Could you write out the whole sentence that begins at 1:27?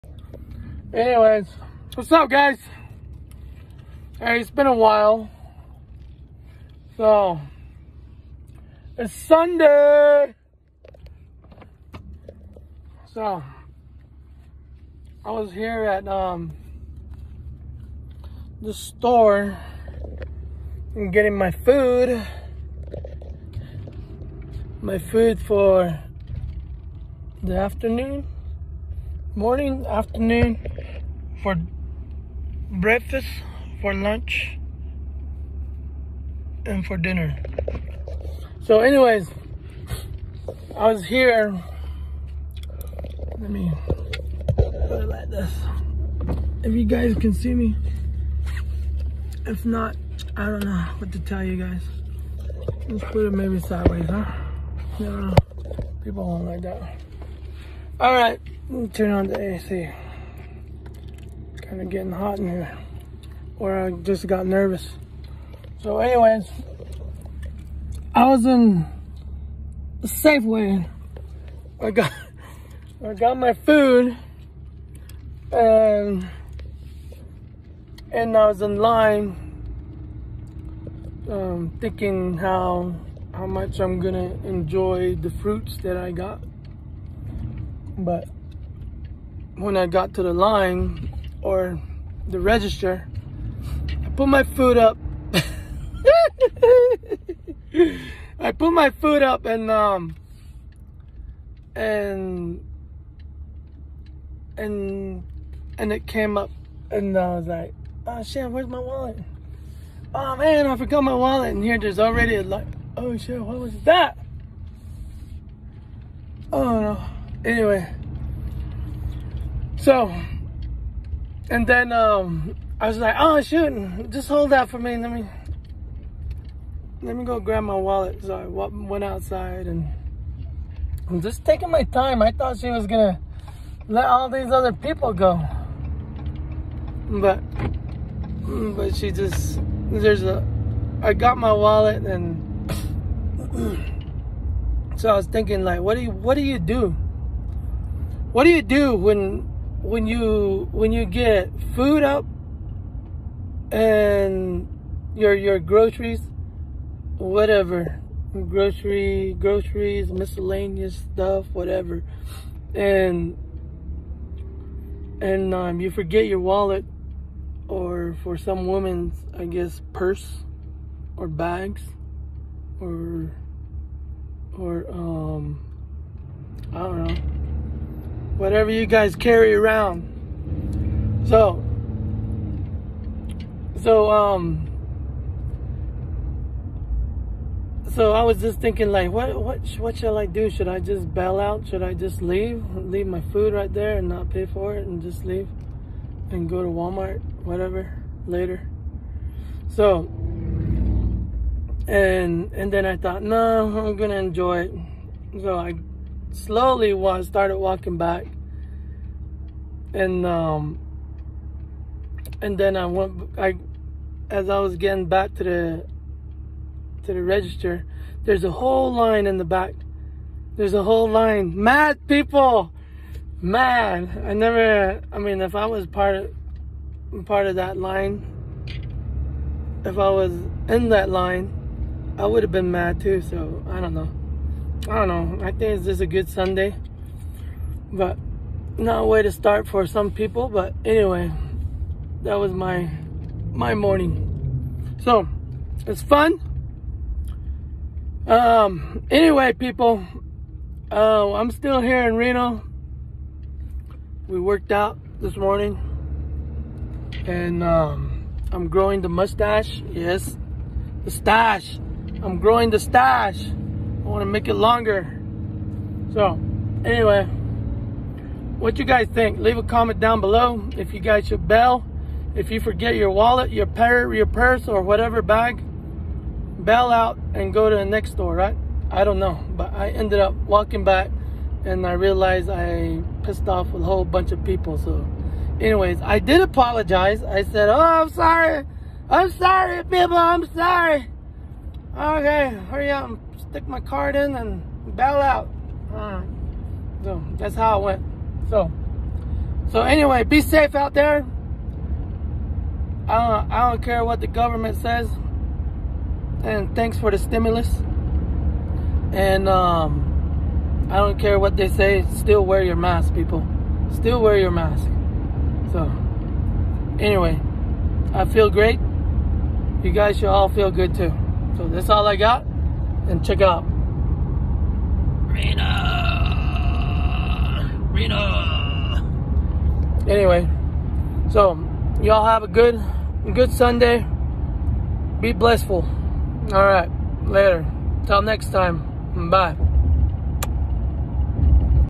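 But when I got to the line, or the register.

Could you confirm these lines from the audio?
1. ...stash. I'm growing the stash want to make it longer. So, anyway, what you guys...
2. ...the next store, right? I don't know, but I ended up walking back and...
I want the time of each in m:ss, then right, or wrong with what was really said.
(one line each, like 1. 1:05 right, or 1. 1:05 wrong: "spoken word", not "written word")
1. 4:21 right
2. 4:37 right.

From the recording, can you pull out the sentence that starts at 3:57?
But not a way to start for some people.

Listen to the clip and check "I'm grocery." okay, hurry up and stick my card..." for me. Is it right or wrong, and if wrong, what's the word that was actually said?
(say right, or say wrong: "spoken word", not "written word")
wrong: "sorry", not "grocery".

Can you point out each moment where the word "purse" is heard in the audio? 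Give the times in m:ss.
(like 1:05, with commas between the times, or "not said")
2:49, 4:34.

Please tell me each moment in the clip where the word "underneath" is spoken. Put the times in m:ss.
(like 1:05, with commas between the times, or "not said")
not said.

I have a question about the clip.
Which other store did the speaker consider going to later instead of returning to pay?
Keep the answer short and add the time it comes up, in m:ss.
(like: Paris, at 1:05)
Walmart, at 3:16.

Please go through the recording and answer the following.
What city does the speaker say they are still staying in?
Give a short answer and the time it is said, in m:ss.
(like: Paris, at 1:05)
Reno, at 4:12.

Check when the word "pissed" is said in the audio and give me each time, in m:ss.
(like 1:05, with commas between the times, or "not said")
4:43.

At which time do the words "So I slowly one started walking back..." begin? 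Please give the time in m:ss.
3:25.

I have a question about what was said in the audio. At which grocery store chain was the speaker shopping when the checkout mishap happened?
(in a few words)
Safeway.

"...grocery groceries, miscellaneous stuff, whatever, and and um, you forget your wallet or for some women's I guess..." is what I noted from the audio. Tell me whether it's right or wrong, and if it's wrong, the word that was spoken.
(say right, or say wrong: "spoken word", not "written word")
right.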